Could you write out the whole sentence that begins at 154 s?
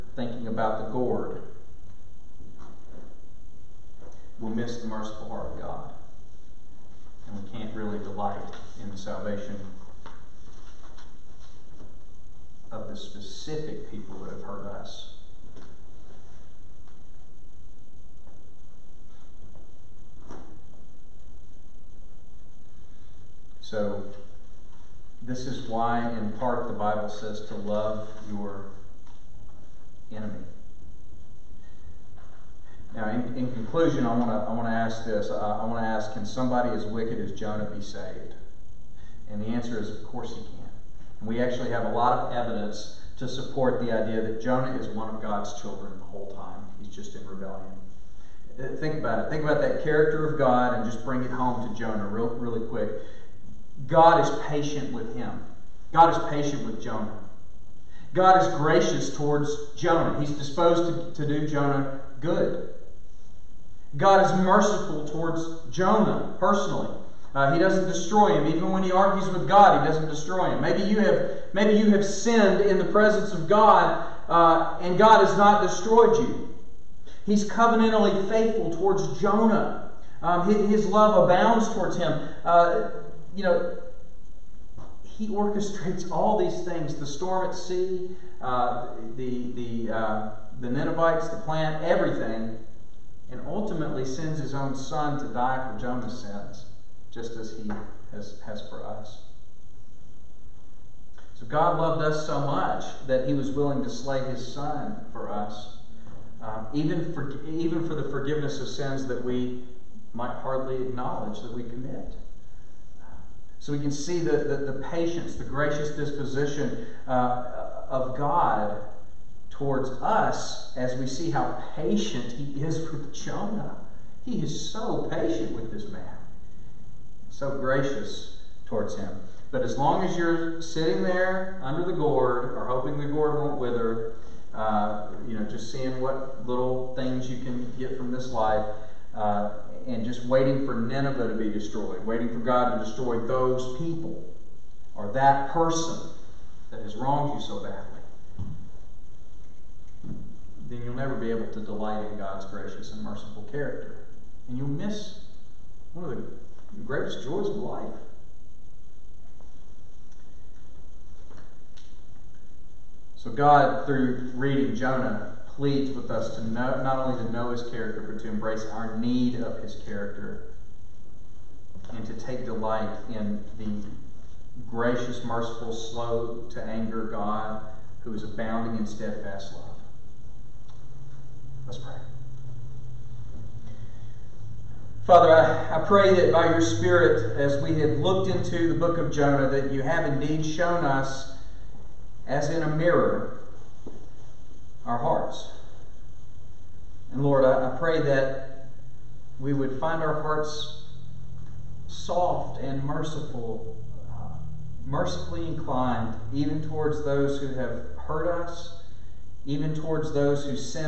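And you'll miss one of the greatest joys of life.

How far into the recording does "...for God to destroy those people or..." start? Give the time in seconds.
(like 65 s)
142 s.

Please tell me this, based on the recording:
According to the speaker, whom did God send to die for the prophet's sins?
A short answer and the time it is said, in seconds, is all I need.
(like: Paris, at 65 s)
his own son, at 94 s.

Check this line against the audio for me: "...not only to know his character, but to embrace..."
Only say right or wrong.
right.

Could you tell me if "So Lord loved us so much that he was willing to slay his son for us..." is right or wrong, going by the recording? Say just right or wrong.
wrong.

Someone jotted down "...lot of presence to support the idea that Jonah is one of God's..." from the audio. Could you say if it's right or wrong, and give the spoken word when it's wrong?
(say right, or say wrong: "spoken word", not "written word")
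wrong: "evidence", not "presence".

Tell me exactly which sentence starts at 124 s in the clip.
He is so patient with this man, so gracious towards him.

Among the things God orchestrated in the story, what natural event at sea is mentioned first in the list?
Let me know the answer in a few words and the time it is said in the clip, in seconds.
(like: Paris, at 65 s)
the storm, at 86 s.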